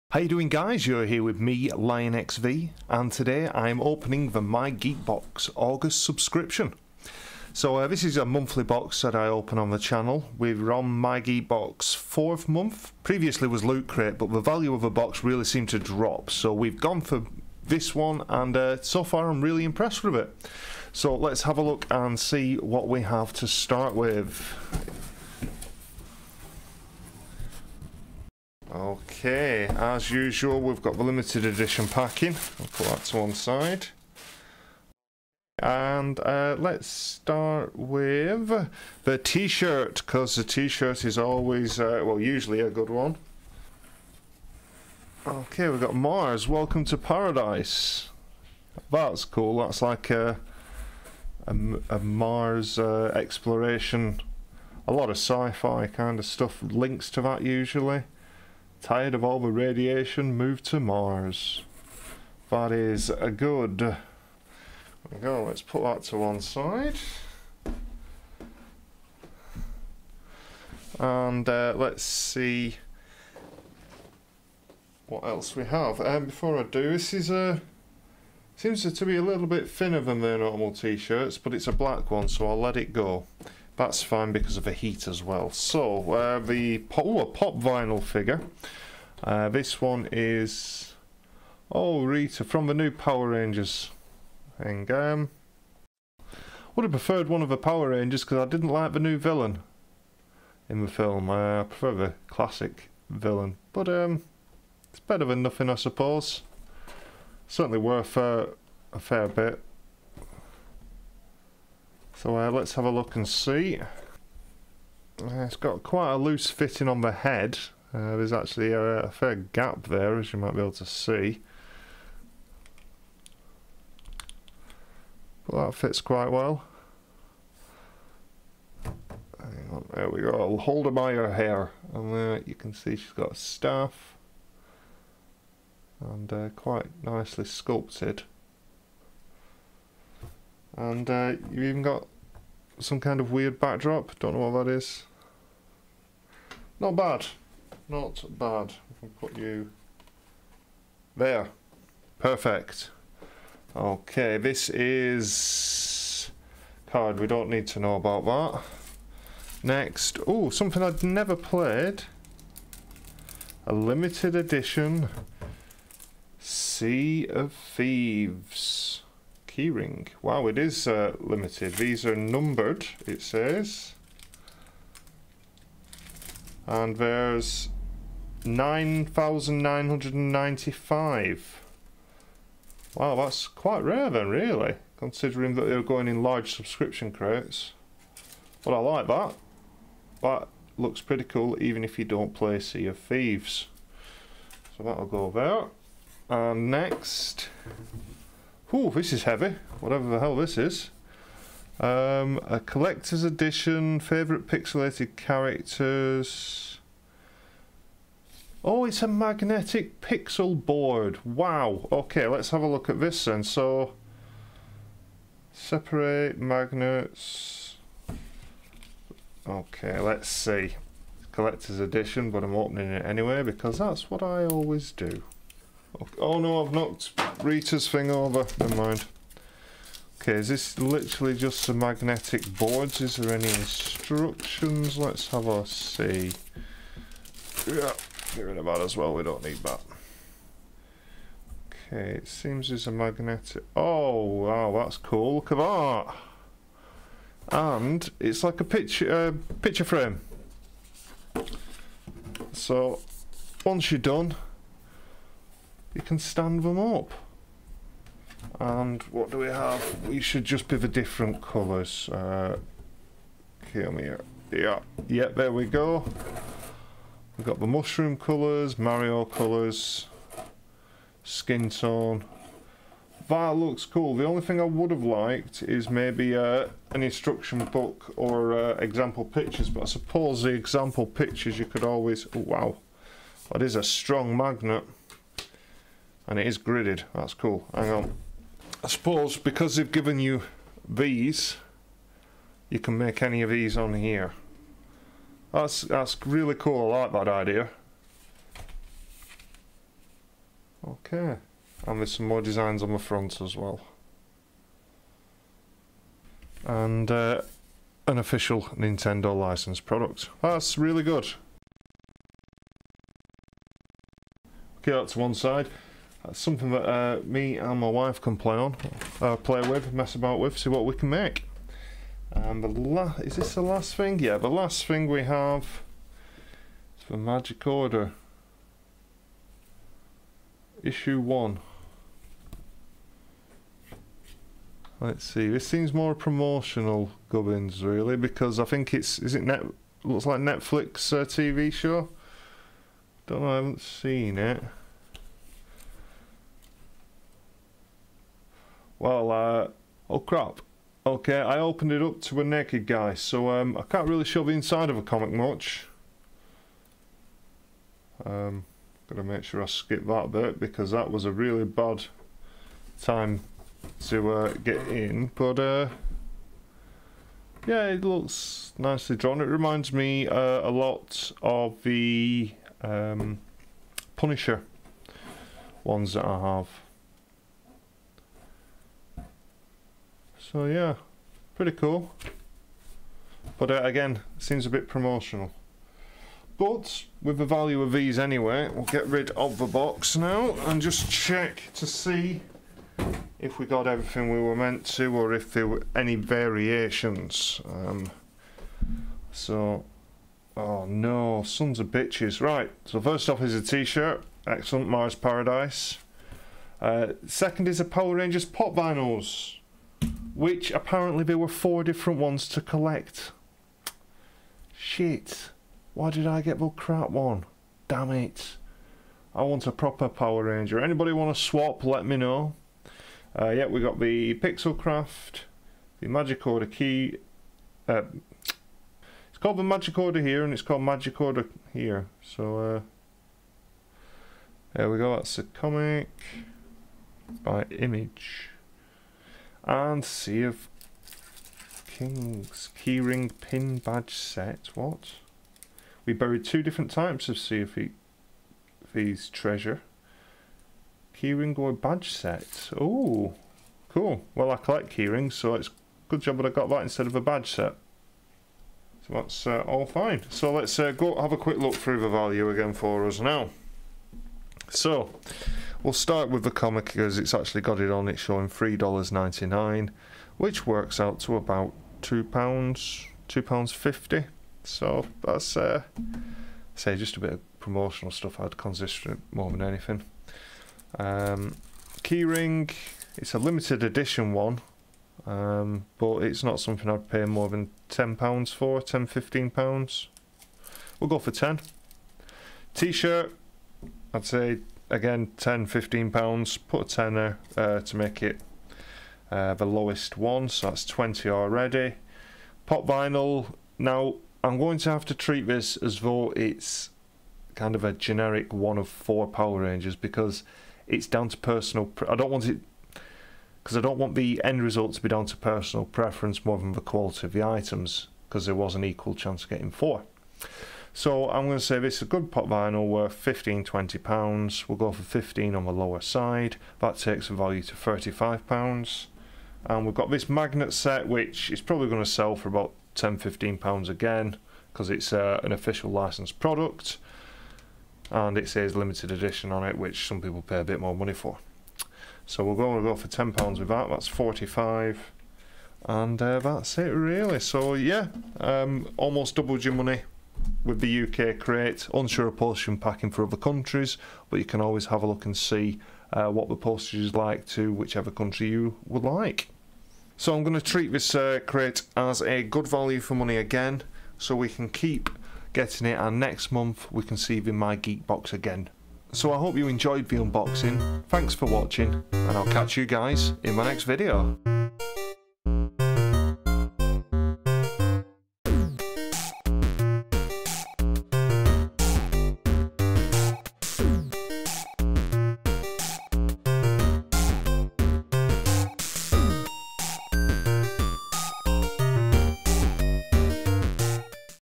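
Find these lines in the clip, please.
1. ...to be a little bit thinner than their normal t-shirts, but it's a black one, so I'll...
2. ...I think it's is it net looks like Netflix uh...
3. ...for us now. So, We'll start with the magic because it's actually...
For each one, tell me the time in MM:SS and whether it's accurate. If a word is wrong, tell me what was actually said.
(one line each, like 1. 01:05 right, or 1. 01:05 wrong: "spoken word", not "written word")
1. 01:18 right
2. 05:38 right
3. 07:42 wrong: "comic", not "magic".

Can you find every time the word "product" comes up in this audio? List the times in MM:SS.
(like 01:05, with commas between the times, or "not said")
05:09, 08:56.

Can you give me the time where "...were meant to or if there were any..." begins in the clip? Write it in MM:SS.
06:34.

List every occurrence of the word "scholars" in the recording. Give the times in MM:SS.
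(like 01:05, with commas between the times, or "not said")
not said.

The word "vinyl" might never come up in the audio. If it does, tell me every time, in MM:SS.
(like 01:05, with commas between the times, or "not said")
01:27, 06:48, 08:22, 08:42.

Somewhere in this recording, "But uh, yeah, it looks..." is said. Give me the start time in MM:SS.
06:05.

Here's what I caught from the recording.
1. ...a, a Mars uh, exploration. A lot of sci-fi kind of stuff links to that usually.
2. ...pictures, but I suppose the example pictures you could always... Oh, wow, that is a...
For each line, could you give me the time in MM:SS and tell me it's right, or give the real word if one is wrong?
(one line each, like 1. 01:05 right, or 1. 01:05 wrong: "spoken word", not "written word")
1. 00:51 right
2. 04:39 right.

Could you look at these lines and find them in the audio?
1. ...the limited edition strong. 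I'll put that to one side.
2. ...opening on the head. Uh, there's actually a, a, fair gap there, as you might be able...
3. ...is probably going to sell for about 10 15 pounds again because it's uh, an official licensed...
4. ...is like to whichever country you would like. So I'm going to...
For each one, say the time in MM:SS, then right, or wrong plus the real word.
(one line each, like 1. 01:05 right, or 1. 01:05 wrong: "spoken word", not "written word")
1. 00:30 wrong: "packing", not "strong"
2. 01:56 wrong: "fitting", not "opening"
3. 08:51 right
4. 09:16 right.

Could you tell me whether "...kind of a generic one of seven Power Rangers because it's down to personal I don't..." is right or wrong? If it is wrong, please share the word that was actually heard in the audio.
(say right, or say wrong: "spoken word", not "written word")
wrong: "four", not "seven".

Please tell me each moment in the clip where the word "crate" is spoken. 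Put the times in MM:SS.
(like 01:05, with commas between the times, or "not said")
00:13, 03:07, 09:11, 09:21.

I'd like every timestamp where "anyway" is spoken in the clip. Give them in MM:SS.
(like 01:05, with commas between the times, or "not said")
03:43, 06:28.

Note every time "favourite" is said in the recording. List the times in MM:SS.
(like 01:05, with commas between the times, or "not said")
03:23.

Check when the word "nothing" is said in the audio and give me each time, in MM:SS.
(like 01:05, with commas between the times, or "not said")
01:45.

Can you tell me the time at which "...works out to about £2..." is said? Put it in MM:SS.
07:50.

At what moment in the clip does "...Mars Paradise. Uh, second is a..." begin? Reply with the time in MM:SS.
06:44.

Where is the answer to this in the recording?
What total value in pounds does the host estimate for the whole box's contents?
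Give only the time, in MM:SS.
09:04.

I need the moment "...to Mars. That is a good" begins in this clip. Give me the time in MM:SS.
01:00.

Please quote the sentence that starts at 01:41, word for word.
Uh, I prefer the classic villain.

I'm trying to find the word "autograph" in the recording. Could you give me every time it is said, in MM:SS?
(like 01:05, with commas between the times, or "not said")
not said.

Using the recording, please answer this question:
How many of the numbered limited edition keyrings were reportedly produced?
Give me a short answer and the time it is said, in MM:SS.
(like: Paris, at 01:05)
9,995, at 02:58.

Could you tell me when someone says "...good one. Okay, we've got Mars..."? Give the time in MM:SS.
00:42.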